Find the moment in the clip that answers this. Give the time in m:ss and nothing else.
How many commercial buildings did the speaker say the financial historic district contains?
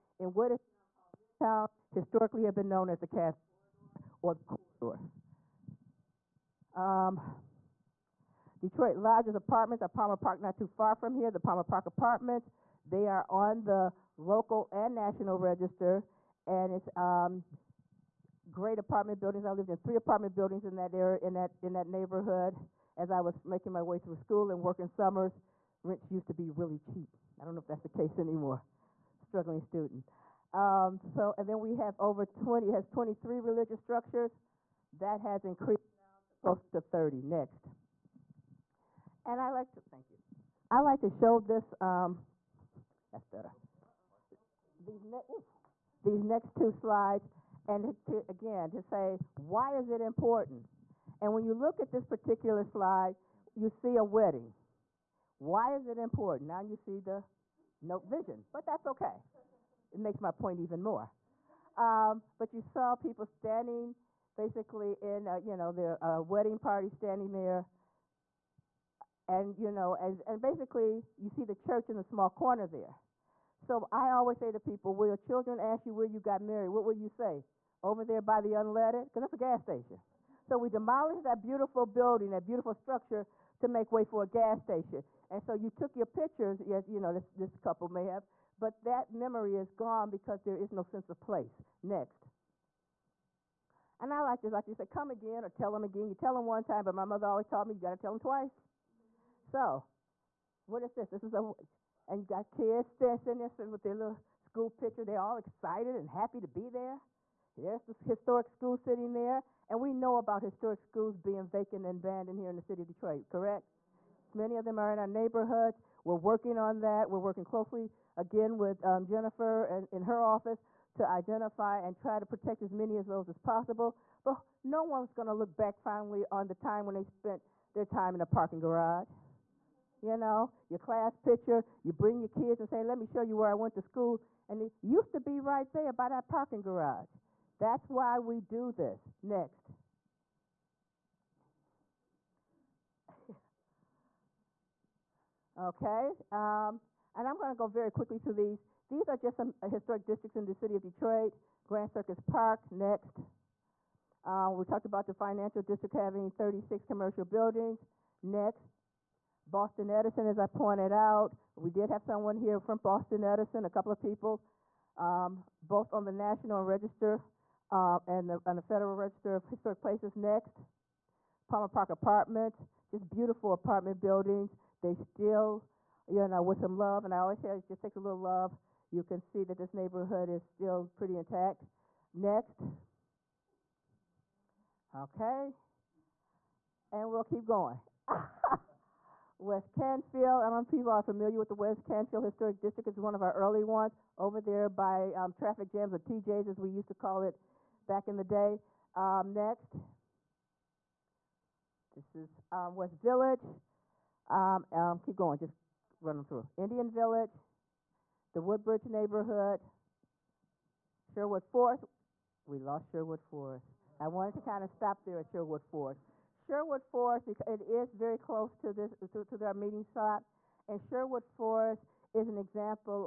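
2:36.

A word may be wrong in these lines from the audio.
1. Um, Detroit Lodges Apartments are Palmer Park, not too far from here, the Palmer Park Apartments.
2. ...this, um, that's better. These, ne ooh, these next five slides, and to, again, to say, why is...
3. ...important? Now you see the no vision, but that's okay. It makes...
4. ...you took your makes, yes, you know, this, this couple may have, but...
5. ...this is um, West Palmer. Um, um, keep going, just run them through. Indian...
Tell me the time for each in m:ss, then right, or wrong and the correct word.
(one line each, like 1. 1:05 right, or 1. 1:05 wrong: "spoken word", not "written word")
1. 0:06 right
2. 0:41 wrong: "two", not "five"
3. 0:55 right
4. 1:25 wrong: "pictures", not "makes"
5. 3:21 wrong: "Village", not "Palmer".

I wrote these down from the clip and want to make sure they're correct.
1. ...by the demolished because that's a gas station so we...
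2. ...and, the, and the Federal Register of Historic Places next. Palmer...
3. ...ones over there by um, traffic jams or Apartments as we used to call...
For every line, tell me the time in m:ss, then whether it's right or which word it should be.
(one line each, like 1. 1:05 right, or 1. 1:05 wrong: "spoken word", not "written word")
1. 1:18 wrong: "unleaded", not "demolished"
2. 2:48 right
3. 3:13 wrong: "TJs", not "Apartments".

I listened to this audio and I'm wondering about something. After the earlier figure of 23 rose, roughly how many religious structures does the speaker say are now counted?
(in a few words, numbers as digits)
close to 30.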